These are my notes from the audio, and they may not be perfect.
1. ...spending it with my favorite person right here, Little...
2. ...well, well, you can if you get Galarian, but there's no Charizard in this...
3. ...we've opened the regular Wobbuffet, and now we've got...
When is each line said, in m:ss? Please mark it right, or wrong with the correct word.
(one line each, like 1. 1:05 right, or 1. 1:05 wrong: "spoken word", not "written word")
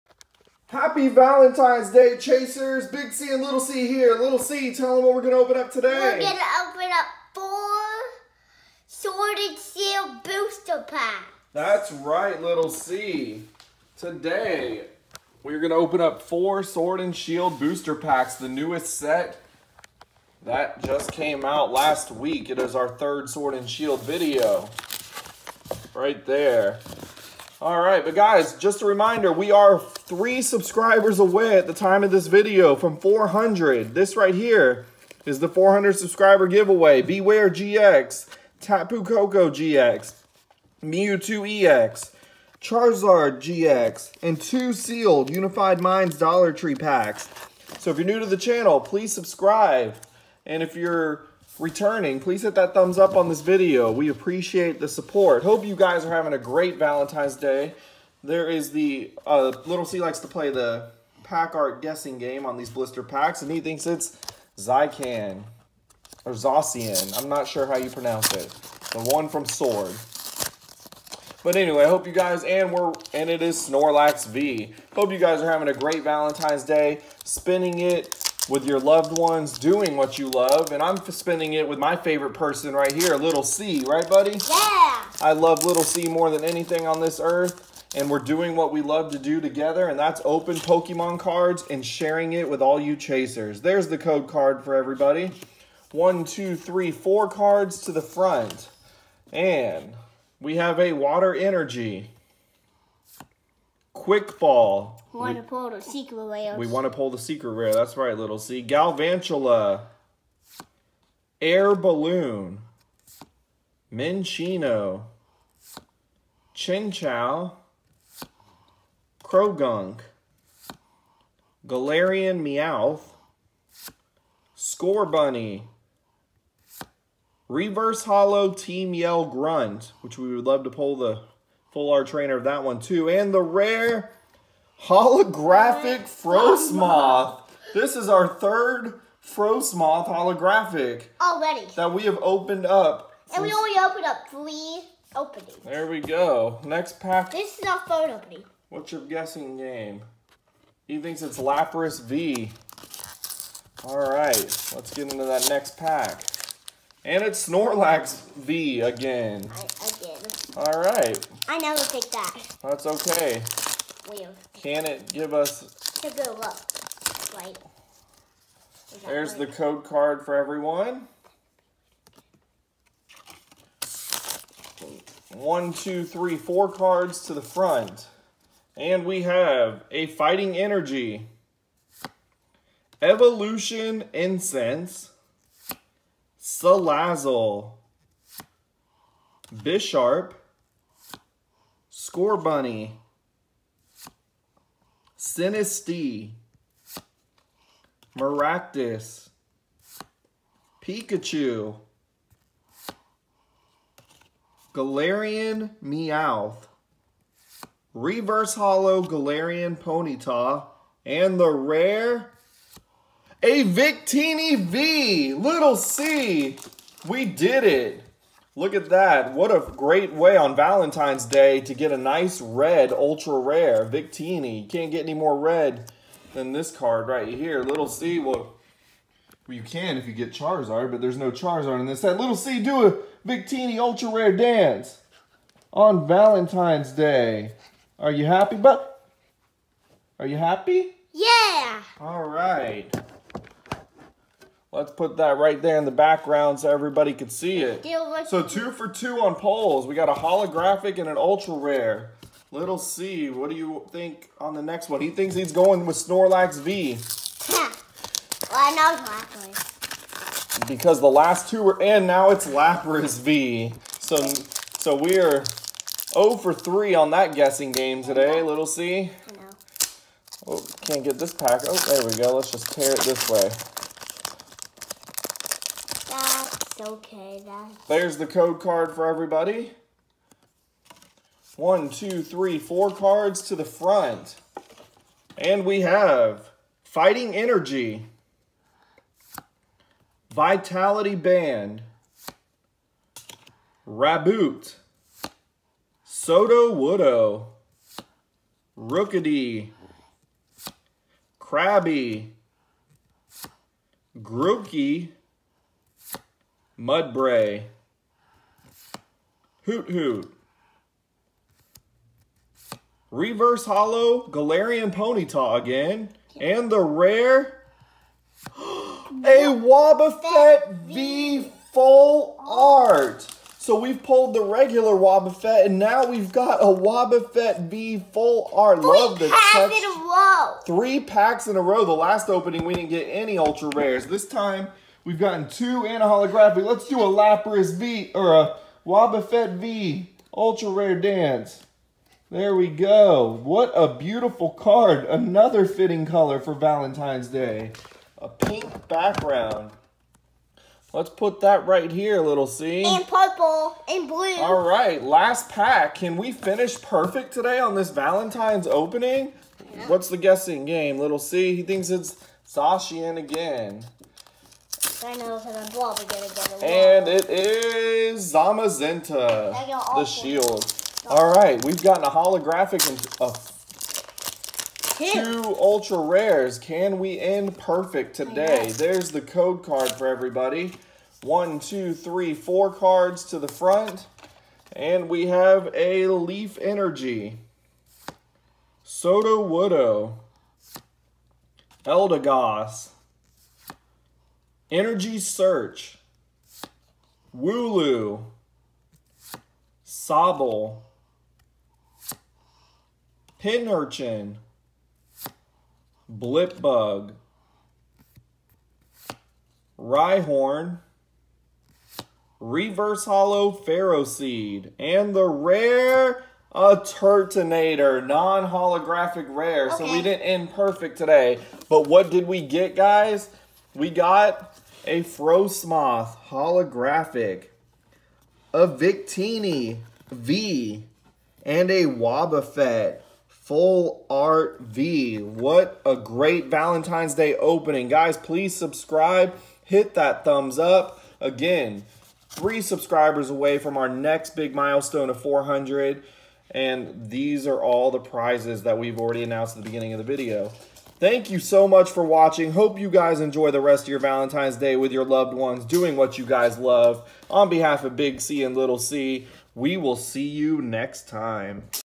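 1. 1:21 right
2. 3:48 wrong: "Charizard", not "Galarian"
3. 5:23 wrong: "pulled", not "opened".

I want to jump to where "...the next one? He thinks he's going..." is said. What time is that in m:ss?
4:14.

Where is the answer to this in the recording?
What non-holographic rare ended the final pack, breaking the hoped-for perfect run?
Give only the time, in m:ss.
6:56.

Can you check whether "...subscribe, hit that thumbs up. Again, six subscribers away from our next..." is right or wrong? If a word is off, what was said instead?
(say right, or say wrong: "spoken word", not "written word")
wrong: "three", not "six".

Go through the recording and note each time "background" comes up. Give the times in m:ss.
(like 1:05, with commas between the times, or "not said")
4:05, 5:48.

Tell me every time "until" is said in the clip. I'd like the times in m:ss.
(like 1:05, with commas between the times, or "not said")
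not said.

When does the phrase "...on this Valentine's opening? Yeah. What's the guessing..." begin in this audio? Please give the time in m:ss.
5:57.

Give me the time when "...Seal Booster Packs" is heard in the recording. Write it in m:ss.
0:09.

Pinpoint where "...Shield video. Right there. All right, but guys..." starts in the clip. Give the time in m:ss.
0:23.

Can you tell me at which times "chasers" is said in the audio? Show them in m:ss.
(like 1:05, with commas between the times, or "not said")
0:02, 1:32.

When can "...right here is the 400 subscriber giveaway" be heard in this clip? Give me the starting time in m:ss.
0:34.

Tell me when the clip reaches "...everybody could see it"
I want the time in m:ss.
4:06.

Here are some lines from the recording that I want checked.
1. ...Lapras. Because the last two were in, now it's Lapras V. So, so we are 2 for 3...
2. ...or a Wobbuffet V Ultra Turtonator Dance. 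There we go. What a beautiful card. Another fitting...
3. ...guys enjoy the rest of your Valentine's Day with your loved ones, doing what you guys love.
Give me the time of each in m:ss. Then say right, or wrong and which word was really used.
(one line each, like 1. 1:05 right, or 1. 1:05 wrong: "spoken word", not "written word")
1. 4:19 wrong: "0", not "2"
2. 5:38 wrong: "Rare", not "Turtonator"
3. 7:32 right.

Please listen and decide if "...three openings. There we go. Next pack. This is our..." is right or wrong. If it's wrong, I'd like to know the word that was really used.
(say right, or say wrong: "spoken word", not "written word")
right.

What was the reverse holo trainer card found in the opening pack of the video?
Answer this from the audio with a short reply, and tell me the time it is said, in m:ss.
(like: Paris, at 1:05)
Team Yell Grunt, at 2:08.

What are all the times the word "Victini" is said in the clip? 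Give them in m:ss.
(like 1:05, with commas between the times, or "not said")
3:33, 3:43, 3:53, 7:08.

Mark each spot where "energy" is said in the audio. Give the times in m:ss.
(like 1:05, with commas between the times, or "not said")
1:41, 3:00, 4:47, 6:26, 6:34.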